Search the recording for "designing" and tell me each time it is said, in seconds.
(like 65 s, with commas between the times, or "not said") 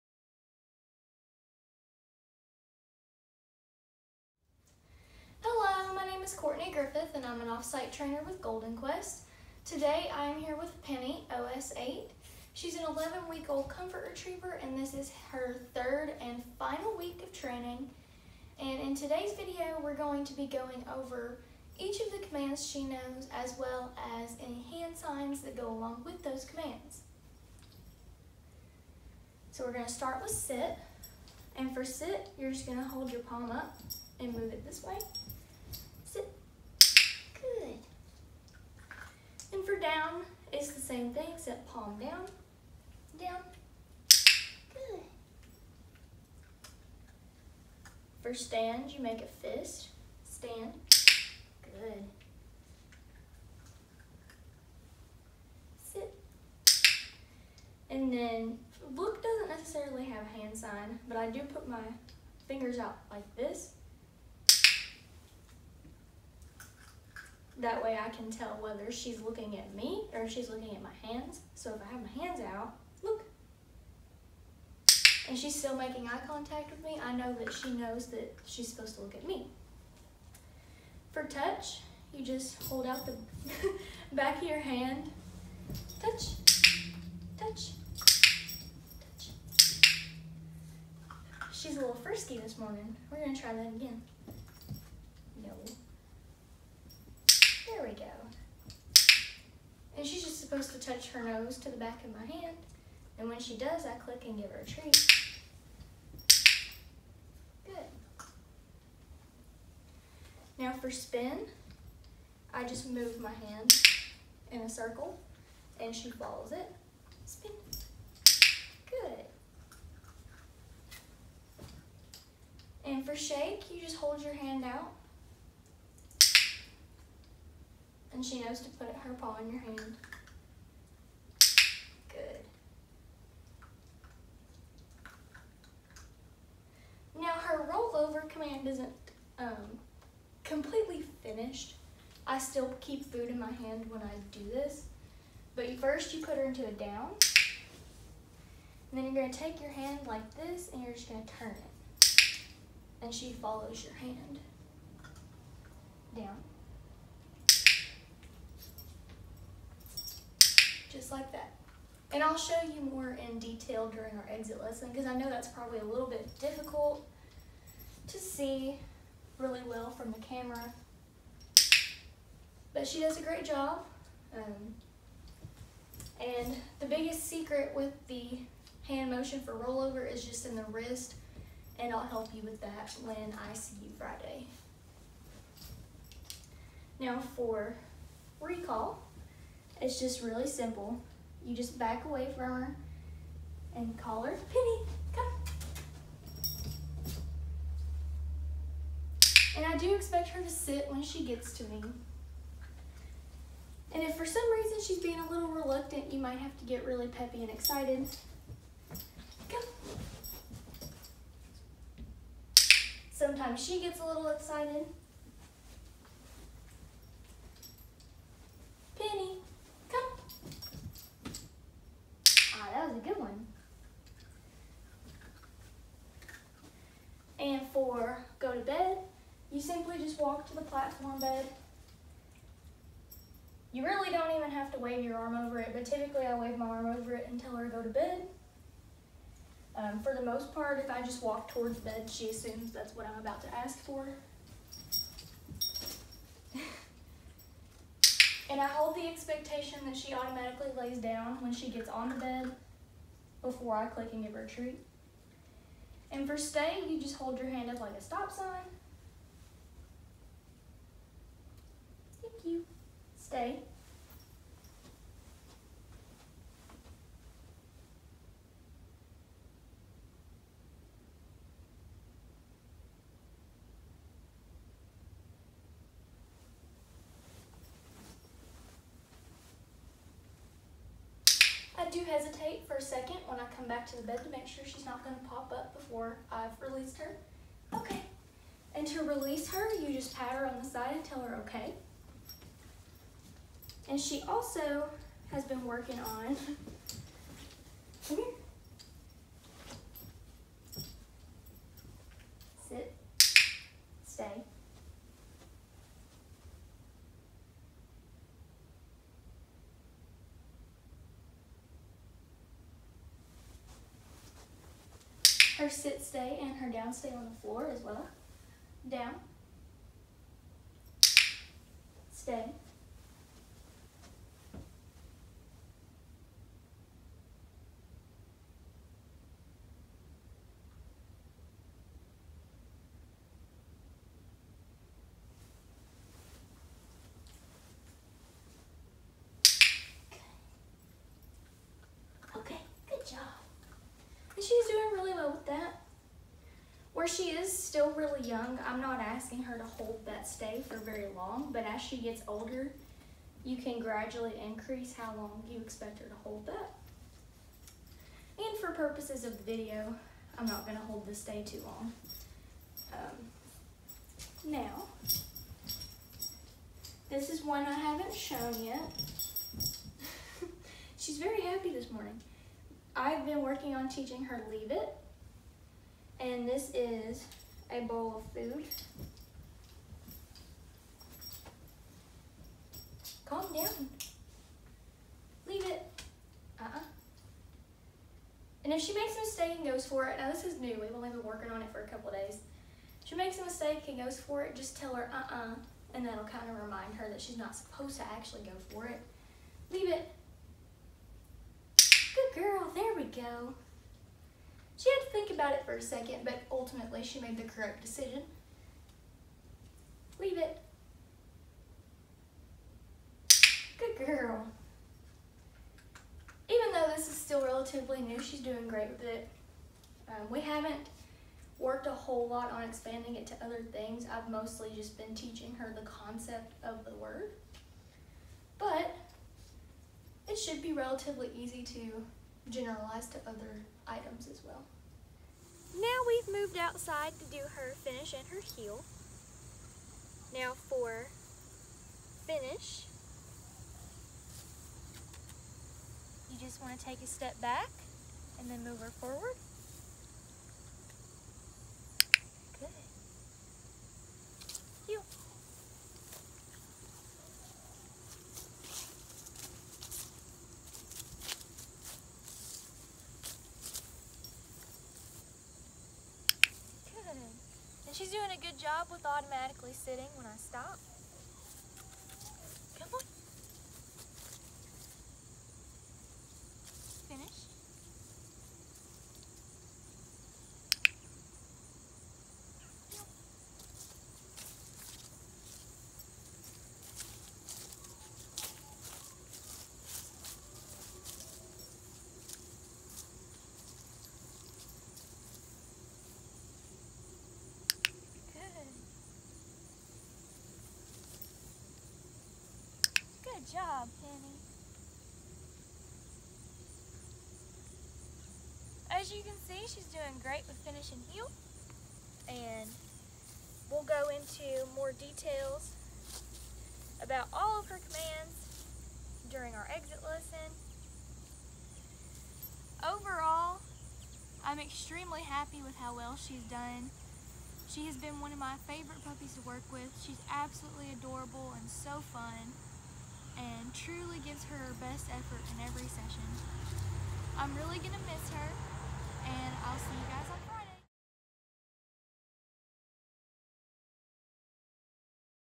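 not said.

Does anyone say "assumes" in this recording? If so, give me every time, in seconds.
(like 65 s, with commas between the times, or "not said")
242 s.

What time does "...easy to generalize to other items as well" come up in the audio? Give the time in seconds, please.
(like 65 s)
431 s.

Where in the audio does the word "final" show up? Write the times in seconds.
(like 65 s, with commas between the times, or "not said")
16 s.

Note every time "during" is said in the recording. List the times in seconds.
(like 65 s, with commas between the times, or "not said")
163 s, 519 s.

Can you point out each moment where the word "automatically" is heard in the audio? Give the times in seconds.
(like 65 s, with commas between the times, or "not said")
250 s, 469 s.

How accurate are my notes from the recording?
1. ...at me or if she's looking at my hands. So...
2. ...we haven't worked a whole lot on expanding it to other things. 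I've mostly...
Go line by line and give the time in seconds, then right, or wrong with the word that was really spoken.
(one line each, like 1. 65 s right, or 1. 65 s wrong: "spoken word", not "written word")
1. 69 s right
2. 420 s right.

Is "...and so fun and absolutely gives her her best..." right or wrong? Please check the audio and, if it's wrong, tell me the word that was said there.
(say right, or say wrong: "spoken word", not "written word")
wrong: "truly", not "absolutely".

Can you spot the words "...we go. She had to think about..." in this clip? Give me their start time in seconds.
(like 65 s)
402 s.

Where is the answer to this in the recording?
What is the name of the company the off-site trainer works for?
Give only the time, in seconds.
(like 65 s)
8 s.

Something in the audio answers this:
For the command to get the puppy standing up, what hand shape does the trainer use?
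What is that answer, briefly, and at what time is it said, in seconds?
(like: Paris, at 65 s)
A fist, at 49 s.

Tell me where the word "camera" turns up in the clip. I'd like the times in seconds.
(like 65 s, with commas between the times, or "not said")
170 s.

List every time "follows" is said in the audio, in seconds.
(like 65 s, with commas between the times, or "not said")
116 s, 153 s.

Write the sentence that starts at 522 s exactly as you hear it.
Overall, I'm extremely happy with how well she's done.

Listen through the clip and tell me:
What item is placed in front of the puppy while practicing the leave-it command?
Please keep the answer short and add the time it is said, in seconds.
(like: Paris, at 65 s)
A bowl of food, at 377 s.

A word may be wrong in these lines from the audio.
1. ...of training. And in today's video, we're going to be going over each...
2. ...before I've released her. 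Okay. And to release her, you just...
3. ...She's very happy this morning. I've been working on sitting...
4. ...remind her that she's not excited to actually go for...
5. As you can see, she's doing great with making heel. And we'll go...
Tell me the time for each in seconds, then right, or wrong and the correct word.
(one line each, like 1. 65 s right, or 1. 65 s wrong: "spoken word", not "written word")
1. 17 s right
2. 285 s right
3. 370 s wrong: "teaching", not "sitting"
4. 396 s wrong: "supposed", not "excited"
5. 508 s wrong: "finishing", not "making".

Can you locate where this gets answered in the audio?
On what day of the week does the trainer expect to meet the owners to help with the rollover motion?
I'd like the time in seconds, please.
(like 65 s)
183 s.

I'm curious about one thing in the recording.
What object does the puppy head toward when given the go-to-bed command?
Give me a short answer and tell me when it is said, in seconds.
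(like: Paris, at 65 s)
Platform bed, at 230 s.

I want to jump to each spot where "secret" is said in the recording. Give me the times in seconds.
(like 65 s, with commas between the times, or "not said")
177 s.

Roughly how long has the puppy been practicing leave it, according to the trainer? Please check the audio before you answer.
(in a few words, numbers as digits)
A couple days.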